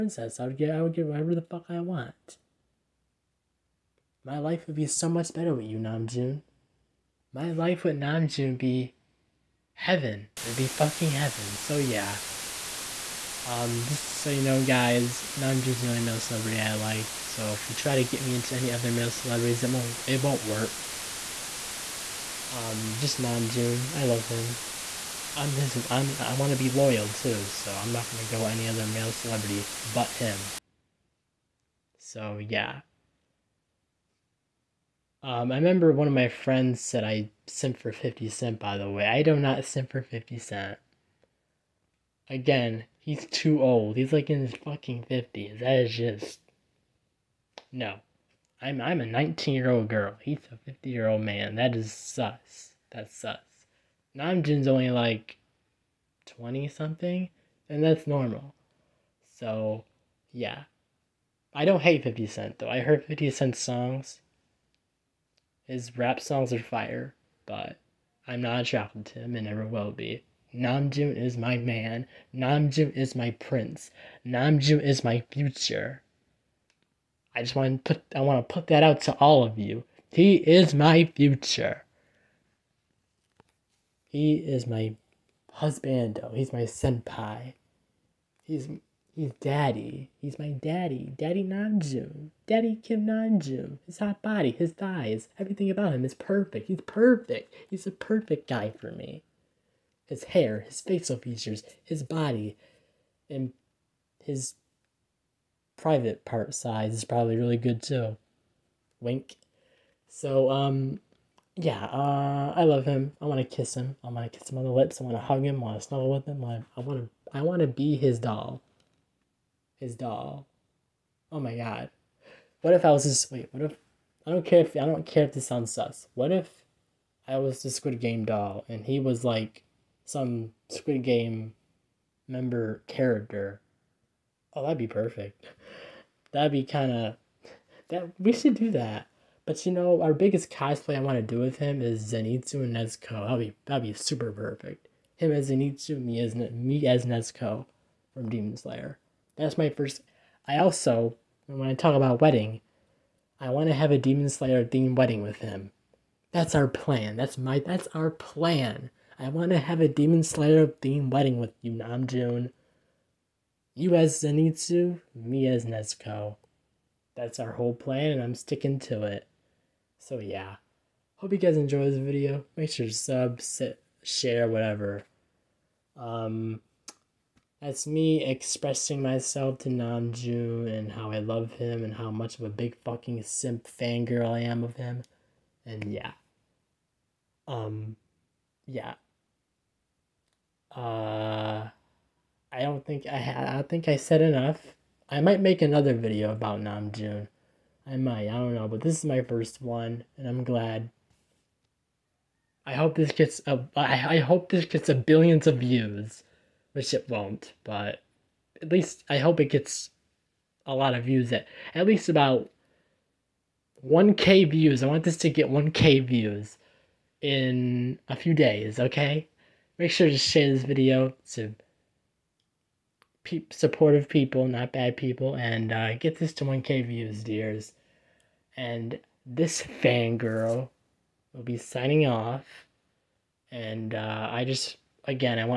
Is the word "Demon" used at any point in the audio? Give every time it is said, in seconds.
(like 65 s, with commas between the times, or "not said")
148 s, 153 s, 159 s.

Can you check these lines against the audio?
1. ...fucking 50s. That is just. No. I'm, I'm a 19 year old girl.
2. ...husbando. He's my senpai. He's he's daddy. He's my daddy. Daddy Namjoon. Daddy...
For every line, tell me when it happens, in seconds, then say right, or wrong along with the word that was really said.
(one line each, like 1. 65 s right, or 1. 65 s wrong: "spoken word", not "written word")
1. 44 s right
2. 85 s right.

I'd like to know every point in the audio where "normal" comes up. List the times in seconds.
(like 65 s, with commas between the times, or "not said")
58 s.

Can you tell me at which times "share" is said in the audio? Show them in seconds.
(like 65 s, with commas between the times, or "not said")
174 s, 220 s.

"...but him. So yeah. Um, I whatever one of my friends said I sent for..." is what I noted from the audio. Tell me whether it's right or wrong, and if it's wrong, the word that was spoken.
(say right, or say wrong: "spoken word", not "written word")
wrong: "remember", not "whatever".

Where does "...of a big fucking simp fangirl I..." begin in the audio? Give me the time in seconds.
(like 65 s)
182 s.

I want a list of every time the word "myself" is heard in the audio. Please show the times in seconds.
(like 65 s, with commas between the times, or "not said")
179 s.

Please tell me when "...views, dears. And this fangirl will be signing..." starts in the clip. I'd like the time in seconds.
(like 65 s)
226 s.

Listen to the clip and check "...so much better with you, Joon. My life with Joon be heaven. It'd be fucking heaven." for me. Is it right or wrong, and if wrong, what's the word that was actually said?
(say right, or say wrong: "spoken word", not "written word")
right.